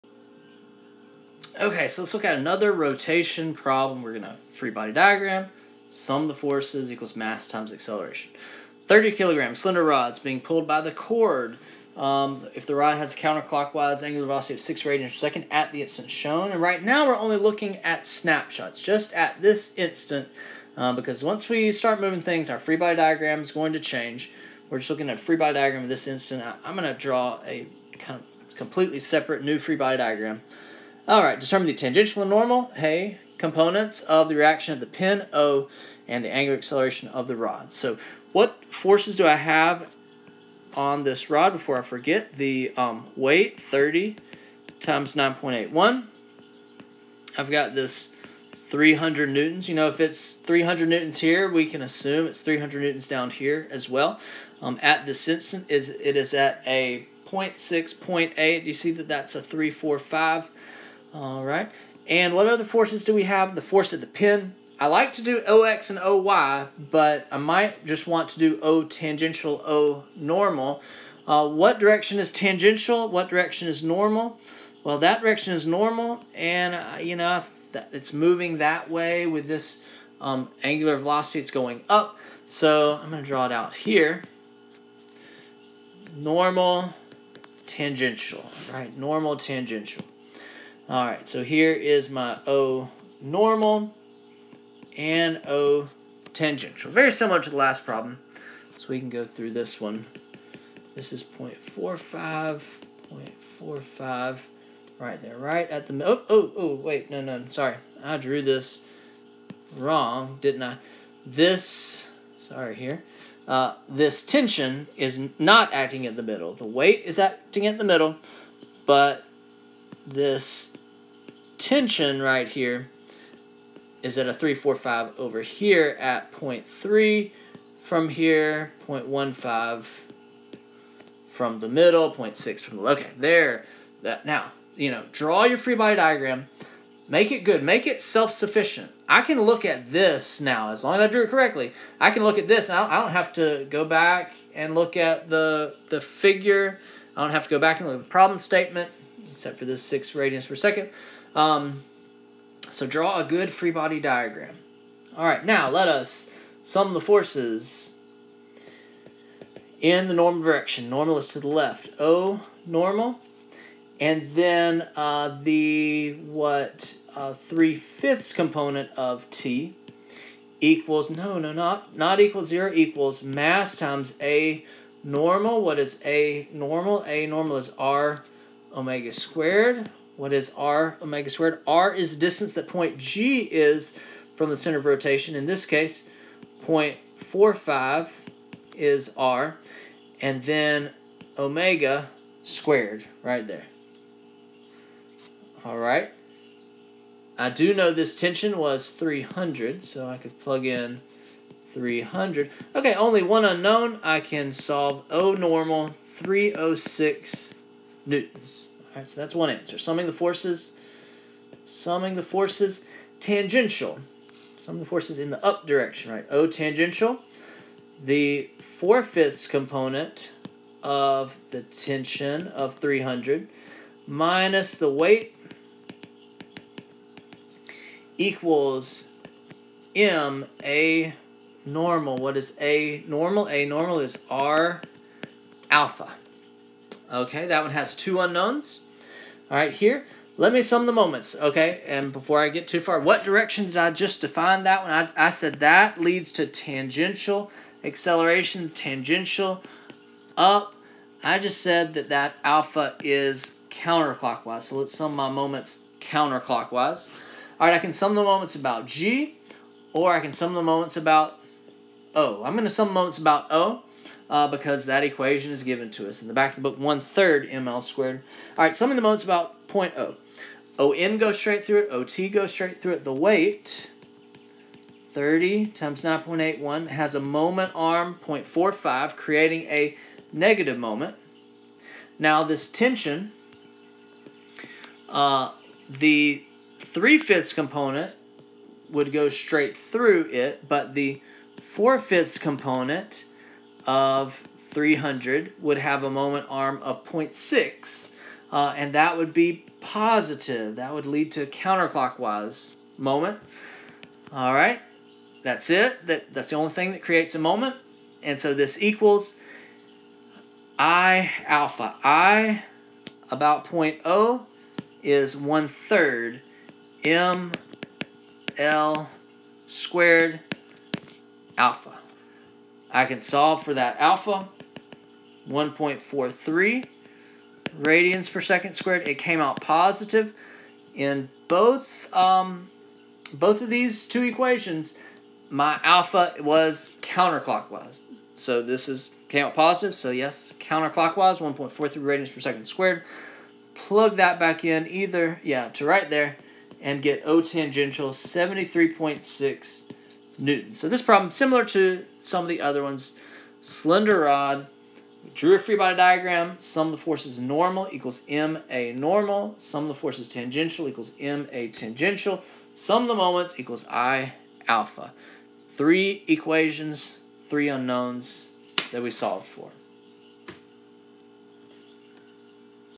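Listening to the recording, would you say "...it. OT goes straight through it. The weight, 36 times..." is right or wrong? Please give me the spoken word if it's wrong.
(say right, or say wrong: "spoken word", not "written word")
wrong: "30", not "36".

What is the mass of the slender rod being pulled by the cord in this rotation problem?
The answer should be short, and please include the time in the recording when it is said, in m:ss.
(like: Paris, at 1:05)
30 kilograms, at 0:08.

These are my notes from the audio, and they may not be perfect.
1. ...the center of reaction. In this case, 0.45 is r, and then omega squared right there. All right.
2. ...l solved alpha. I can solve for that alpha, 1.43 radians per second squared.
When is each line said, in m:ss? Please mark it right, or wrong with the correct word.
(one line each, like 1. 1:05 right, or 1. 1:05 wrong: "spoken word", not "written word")
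1. 3:04 wrong: "rotation", not "reaction"
2. 5:18 wrong: "squared", not "solved".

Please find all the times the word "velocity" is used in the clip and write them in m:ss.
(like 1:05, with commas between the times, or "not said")
0:14, 1:20.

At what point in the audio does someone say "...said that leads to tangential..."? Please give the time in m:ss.
4:05.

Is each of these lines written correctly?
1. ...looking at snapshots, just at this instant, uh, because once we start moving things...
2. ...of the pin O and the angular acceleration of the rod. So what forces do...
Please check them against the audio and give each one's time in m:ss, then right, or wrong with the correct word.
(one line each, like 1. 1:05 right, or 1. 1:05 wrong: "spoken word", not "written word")
1. 0:17 right
2. 0:34 right.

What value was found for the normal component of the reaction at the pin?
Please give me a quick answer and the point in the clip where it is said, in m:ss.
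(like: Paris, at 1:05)
306 newtons, at 3:26.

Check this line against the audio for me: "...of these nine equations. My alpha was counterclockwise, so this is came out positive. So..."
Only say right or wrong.
wrong.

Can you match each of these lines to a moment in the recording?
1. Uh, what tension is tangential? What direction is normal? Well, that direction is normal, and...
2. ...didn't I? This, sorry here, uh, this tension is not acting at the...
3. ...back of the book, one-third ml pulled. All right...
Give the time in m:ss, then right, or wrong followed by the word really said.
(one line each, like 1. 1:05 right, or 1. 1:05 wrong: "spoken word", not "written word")
1. 1:11 wrong: "direction", not "tension"
2. 1:50 right
3. 4:26 wrong: "squared", not "pulled".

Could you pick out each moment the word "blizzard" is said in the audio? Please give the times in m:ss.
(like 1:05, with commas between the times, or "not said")
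not said.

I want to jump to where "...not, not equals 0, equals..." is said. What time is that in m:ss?
2:51.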